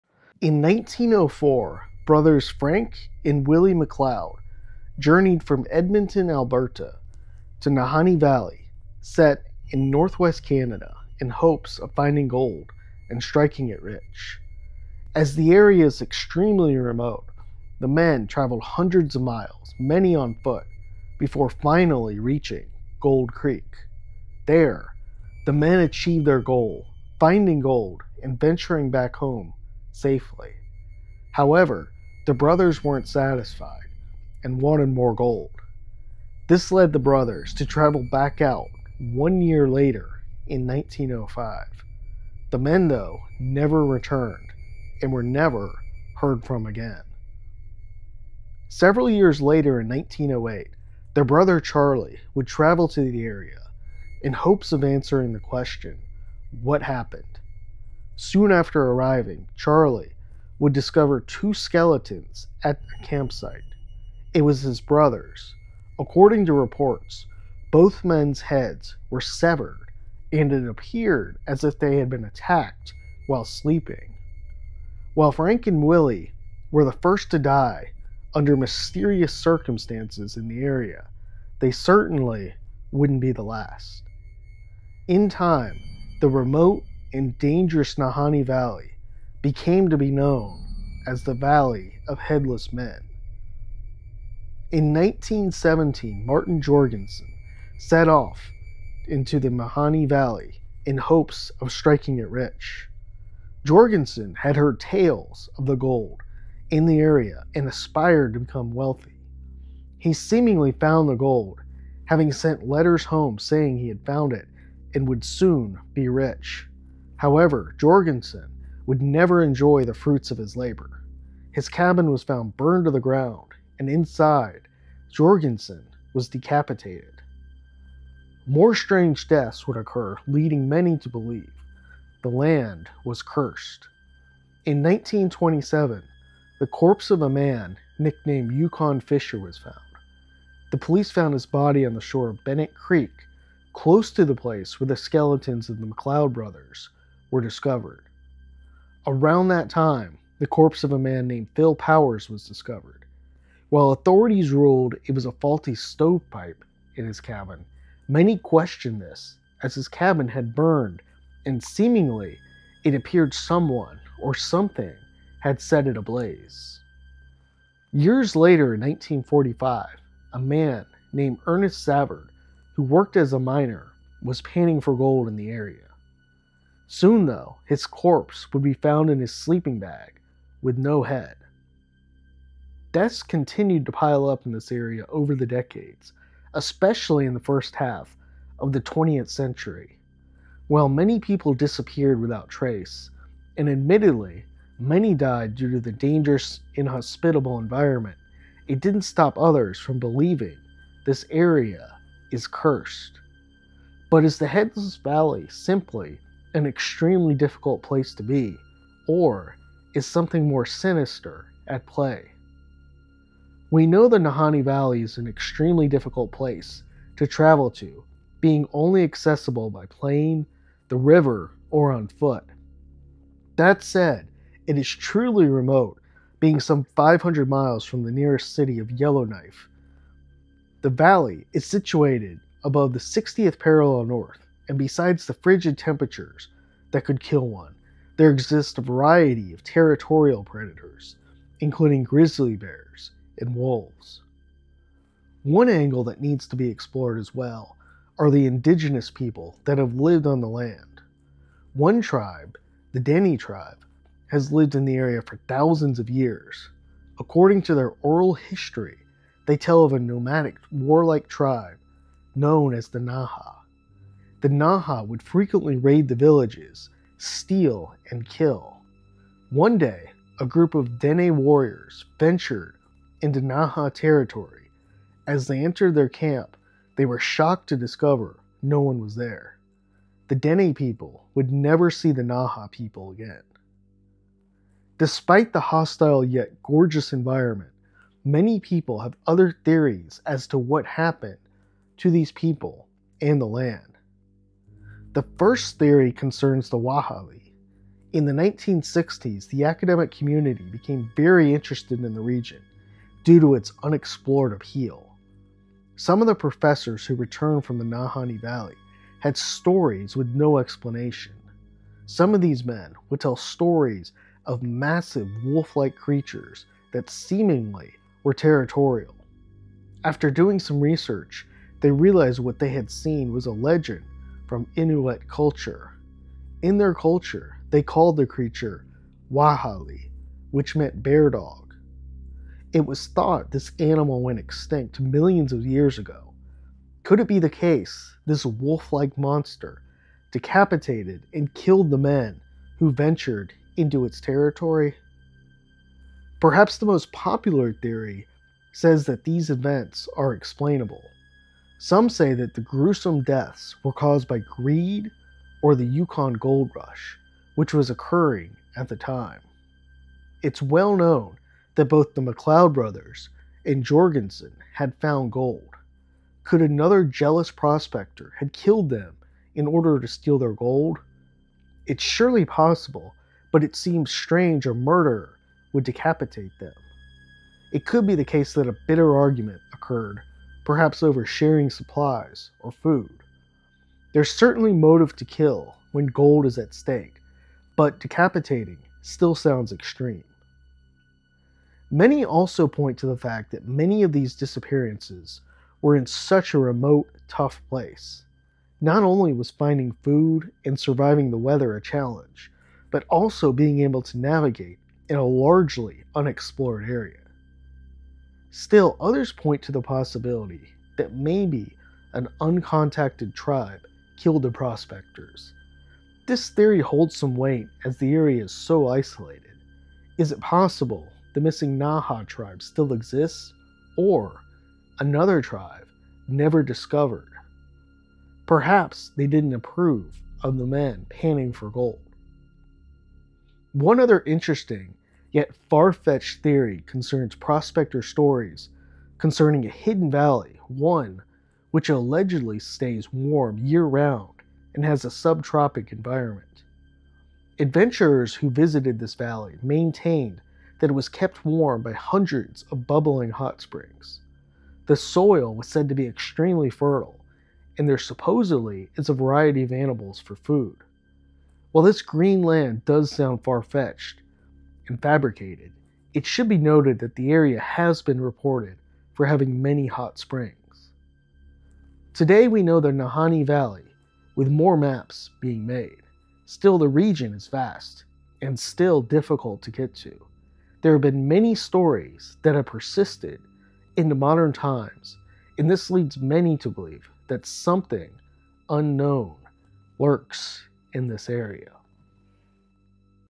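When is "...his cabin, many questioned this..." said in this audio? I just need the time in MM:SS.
02:37.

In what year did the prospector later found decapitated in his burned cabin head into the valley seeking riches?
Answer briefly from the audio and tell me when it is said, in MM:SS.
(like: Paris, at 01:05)
1917, at 01:34.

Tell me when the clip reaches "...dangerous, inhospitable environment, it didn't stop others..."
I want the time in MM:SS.
03:15.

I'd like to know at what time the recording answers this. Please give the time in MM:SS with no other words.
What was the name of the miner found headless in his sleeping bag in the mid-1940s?
02:51.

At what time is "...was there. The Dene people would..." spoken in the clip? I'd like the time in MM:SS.
04:38.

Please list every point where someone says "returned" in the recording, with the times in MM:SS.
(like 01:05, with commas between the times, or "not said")
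00:43, 05:07.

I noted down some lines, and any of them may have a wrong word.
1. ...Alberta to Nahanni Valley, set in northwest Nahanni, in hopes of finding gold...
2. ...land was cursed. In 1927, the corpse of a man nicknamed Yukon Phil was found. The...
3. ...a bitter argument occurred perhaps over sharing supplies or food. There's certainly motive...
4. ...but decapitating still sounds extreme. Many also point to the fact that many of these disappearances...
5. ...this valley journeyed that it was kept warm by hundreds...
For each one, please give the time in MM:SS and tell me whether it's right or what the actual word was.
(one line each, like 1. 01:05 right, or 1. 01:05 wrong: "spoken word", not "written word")
1. 00:06 wrong: "Canada", not "Nahanni"
2. 02:12 wrong: "Fisher", not "Phil"
3. 06:18 right
4. 06:27 right
5. 07:28 wrong: "maintained", not "journeyed".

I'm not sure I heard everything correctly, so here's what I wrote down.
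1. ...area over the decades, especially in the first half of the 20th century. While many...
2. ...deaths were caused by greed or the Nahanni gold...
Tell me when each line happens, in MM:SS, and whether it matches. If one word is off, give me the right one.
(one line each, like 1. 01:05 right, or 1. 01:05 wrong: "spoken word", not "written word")
1. 03:04 right
2. 05:53 wrong: "Yukon", not "Nahanni".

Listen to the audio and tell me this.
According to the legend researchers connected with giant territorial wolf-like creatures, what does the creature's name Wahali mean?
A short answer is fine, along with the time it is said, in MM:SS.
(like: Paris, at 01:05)
Bear dog, at 05:31.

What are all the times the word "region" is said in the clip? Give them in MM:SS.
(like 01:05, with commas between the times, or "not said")
05:02, 07:56.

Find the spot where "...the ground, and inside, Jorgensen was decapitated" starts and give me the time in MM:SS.
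02:02.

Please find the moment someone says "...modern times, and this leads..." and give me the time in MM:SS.
08:04.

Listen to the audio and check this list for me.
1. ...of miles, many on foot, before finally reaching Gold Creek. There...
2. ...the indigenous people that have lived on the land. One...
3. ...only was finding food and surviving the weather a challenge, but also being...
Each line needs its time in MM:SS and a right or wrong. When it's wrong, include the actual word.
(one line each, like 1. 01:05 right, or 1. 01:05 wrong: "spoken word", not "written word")
1. 00:19 right
2. 04:08 right
3. 06:39 right.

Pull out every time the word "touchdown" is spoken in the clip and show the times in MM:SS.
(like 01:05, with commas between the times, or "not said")
not said.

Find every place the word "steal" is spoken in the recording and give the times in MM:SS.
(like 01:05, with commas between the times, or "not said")
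04:27, 06:10.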